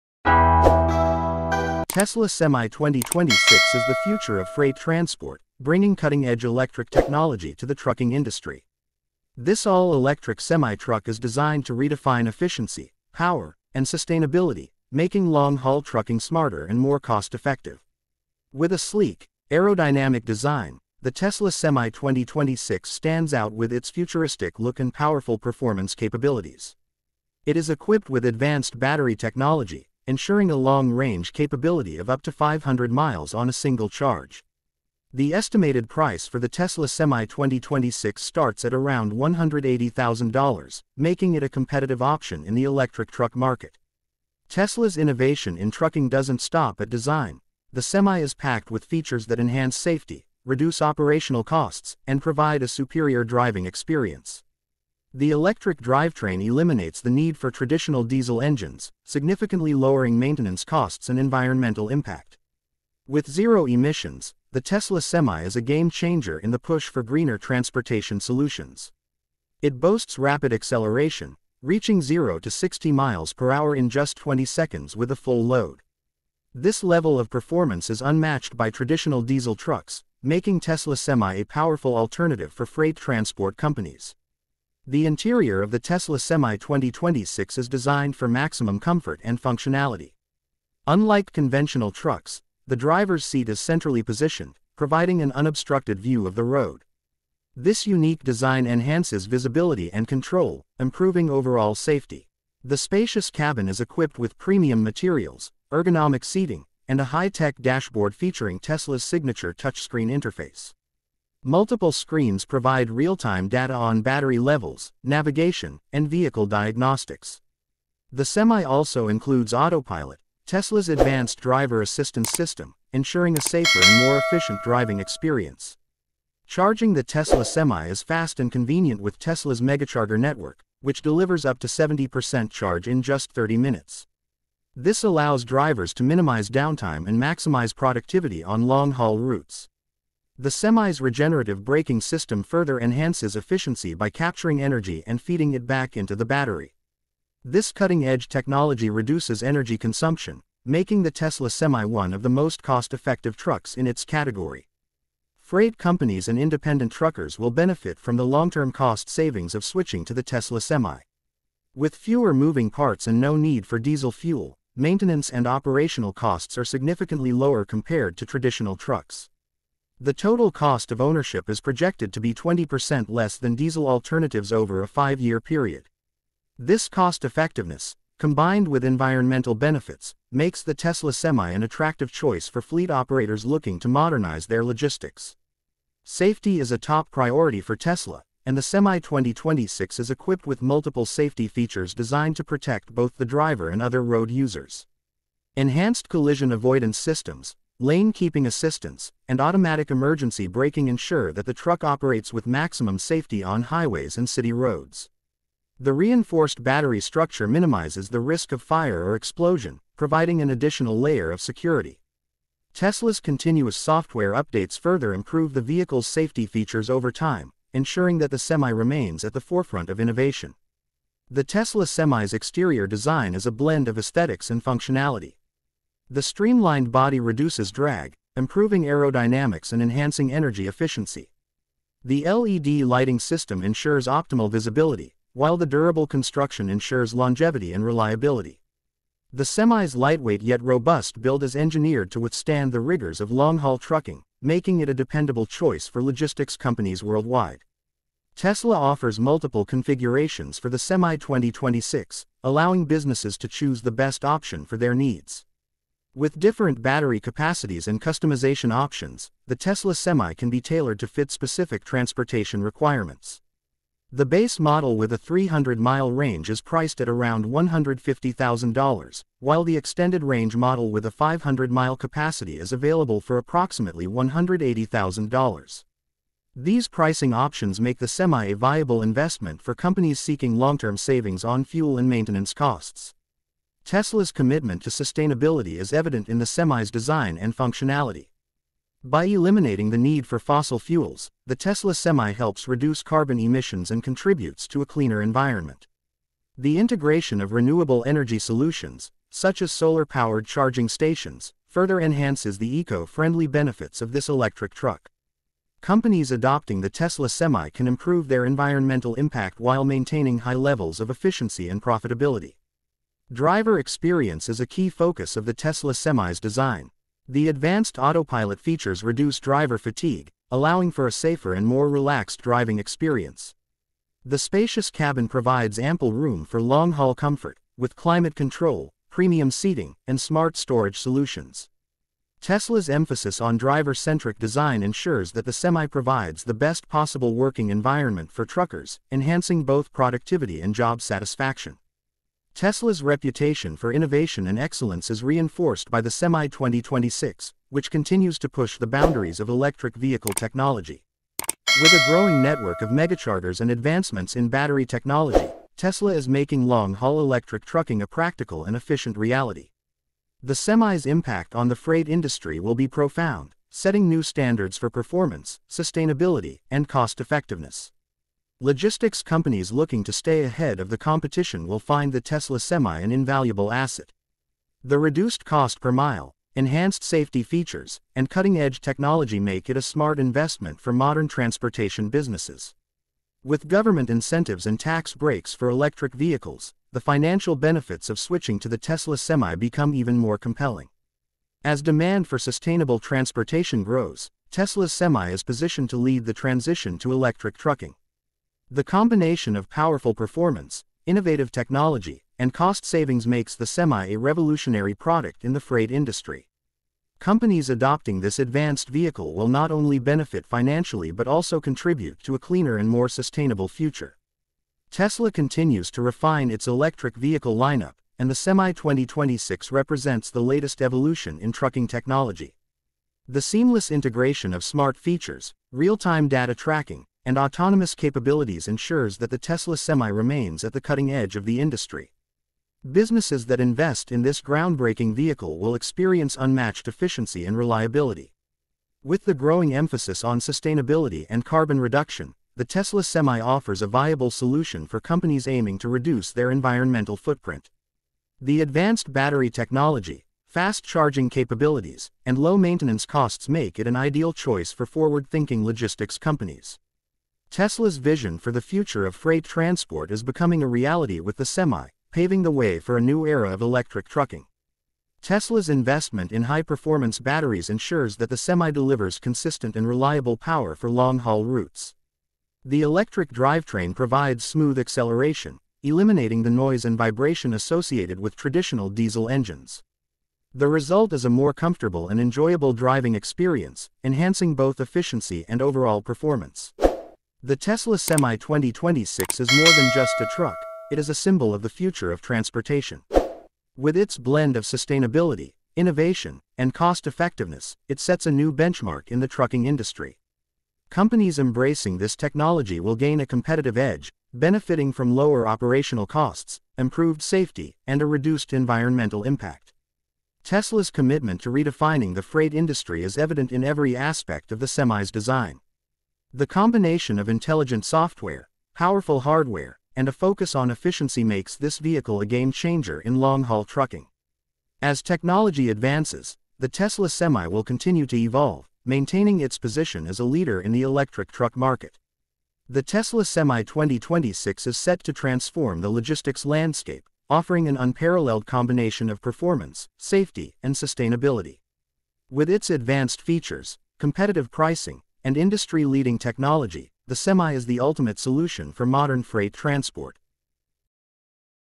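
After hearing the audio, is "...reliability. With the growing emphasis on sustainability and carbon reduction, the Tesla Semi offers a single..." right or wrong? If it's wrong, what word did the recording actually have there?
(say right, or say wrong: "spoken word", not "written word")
wrong: "viable", not "single".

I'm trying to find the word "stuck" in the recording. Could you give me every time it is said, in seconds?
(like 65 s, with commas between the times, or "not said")
not said.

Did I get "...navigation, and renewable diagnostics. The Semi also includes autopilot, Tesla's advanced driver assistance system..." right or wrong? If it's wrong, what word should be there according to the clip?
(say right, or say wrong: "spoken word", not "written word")
wrong: "vehicle", not "renewable".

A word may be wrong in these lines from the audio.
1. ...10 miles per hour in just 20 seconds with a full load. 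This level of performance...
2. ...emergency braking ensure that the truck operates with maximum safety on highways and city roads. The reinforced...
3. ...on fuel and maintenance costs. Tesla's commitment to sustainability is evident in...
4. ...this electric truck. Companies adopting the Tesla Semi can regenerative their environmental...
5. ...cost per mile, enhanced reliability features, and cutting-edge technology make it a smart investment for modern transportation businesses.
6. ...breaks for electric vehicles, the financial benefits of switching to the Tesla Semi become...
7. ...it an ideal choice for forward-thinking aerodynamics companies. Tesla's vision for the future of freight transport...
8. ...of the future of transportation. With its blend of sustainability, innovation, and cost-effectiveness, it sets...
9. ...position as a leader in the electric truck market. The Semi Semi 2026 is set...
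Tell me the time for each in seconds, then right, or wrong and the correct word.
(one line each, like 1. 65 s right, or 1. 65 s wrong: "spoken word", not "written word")
1. 72 s wrong: "60", not "10"
2. 199 s right
3. 281 s right
4. 304 s wrong: "improve", not "regenerative"
5. 375 s wrong: "safety", not "reliability"
6. 385 s right
7. 453 s wrong: "logistics", not "aerodynamics"
8. 491 s right
9. 529 s wrong: "Tesla", not "Semi".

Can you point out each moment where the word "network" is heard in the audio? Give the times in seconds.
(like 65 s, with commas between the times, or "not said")
130 s, 352 s.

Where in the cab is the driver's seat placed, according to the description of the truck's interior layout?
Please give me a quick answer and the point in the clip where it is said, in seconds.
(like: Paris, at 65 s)
Centrally, at 93 s.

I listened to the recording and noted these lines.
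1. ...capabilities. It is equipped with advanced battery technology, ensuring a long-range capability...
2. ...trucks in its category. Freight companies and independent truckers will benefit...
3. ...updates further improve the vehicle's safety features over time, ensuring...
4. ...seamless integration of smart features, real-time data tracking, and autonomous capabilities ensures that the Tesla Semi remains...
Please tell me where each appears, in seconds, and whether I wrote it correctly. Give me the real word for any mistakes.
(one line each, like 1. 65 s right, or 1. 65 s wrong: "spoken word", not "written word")
1. 25 s right
2. 153 s right
3. 214 s right
4. 423 s right.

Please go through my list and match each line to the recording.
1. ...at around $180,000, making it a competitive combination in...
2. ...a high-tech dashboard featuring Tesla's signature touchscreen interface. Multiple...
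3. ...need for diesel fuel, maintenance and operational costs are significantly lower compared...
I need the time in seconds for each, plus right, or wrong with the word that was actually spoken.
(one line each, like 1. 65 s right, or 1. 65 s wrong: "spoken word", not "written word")
1. 38 s wrong: "option", not "combination"
2. 106 s right
3. 163 s right.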